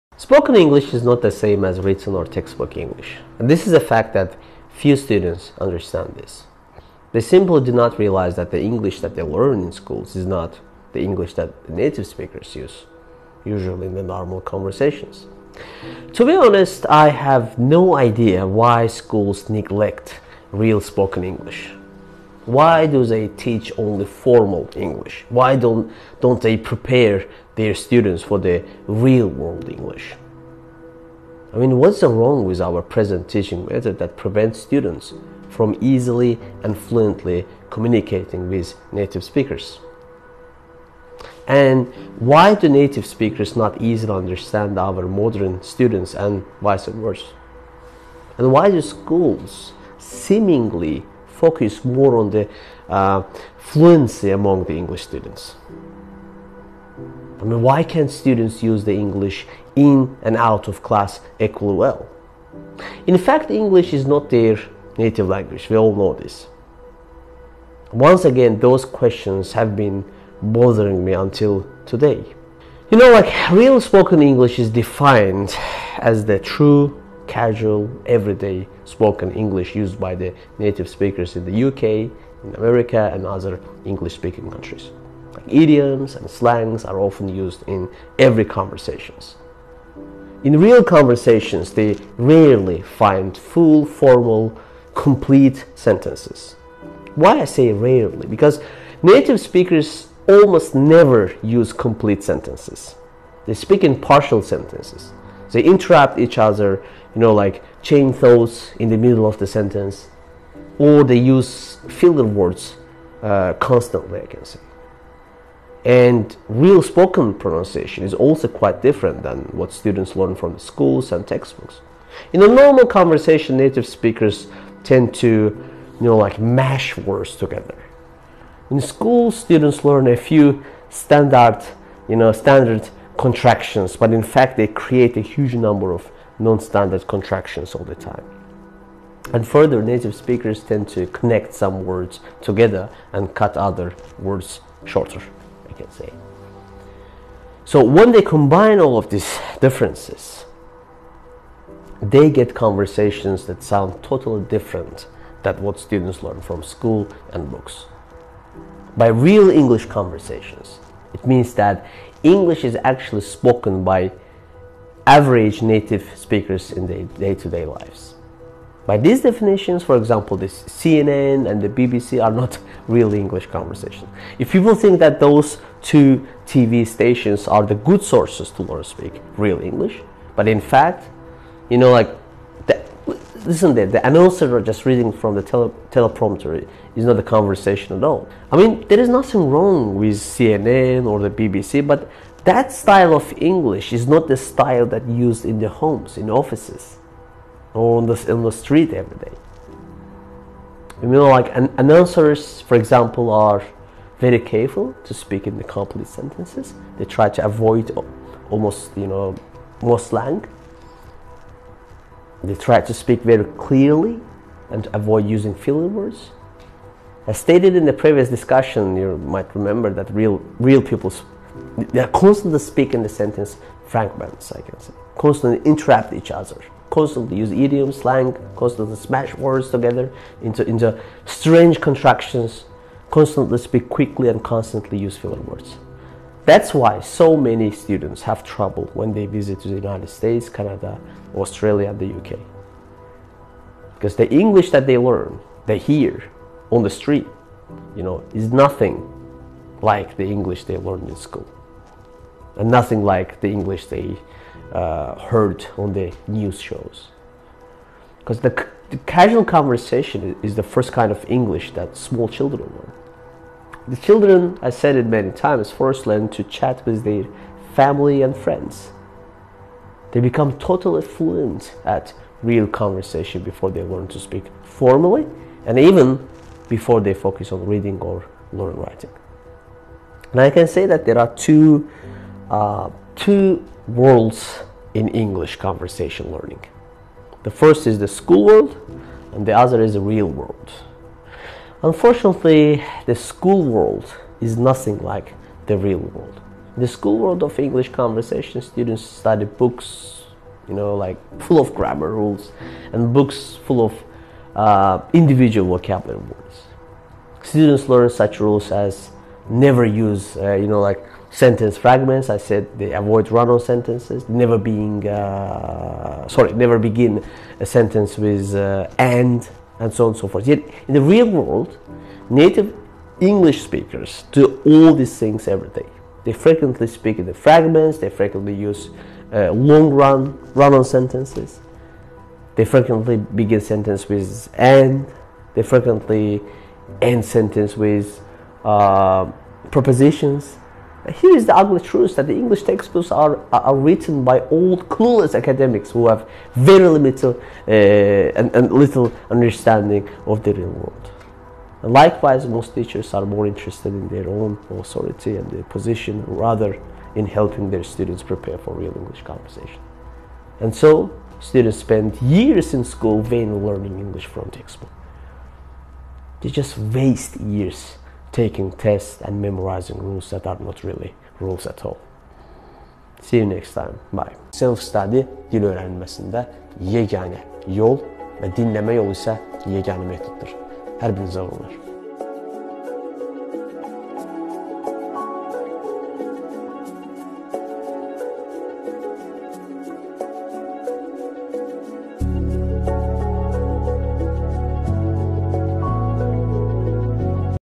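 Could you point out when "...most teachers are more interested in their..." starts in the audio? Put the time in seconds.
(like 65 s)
352 s.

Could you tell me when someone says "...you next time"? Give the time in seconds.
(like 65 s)
373 s.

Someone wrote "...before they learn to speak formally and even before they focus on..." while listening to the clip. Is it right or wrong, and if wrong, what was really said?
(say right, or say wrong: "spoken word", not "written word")
right.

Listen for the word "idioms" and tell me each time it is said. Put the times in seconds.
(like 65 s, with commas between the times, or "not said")
85 s, 227 s.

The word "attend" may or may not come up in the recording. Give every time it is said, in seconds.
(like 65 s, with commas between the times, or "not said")
not said.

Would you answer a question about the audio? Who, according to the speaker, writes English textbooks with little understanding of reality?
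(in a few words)
old clueless academics.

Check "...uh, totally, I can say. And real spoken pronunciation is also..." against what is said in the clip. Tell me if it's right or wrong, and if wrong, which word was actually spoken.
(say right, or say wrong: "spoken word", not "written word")
wrong: "constantly", not "totally".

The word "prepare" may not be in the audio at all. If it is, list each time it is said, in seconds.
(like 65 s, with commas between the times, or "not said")
26 s, 358 s.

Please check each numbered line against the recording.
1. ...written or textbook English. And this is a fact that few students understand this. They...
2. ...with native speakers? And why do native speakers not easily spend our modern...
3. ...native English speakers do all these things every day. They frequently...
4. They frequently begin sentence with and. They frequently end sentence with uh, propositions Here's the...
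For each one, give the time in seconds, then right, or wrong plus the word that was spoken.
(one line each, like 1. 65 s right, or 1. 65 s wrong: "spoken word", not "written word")
1. 1 s right
2. 38 s wrong: "understand", not "spend"
3. 322 s right
4. 332 s right.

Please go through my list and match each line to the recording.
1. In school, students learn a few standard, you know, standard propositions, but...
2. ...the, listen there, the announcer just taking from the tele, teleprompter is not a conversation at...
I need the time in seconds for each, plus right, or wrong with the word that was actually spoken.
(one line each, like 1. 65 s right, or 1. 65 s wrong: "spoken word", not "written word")
1. 128 s wrong: "contractions", not "propositions"
2. 182 s wrong: "reading", not "taking".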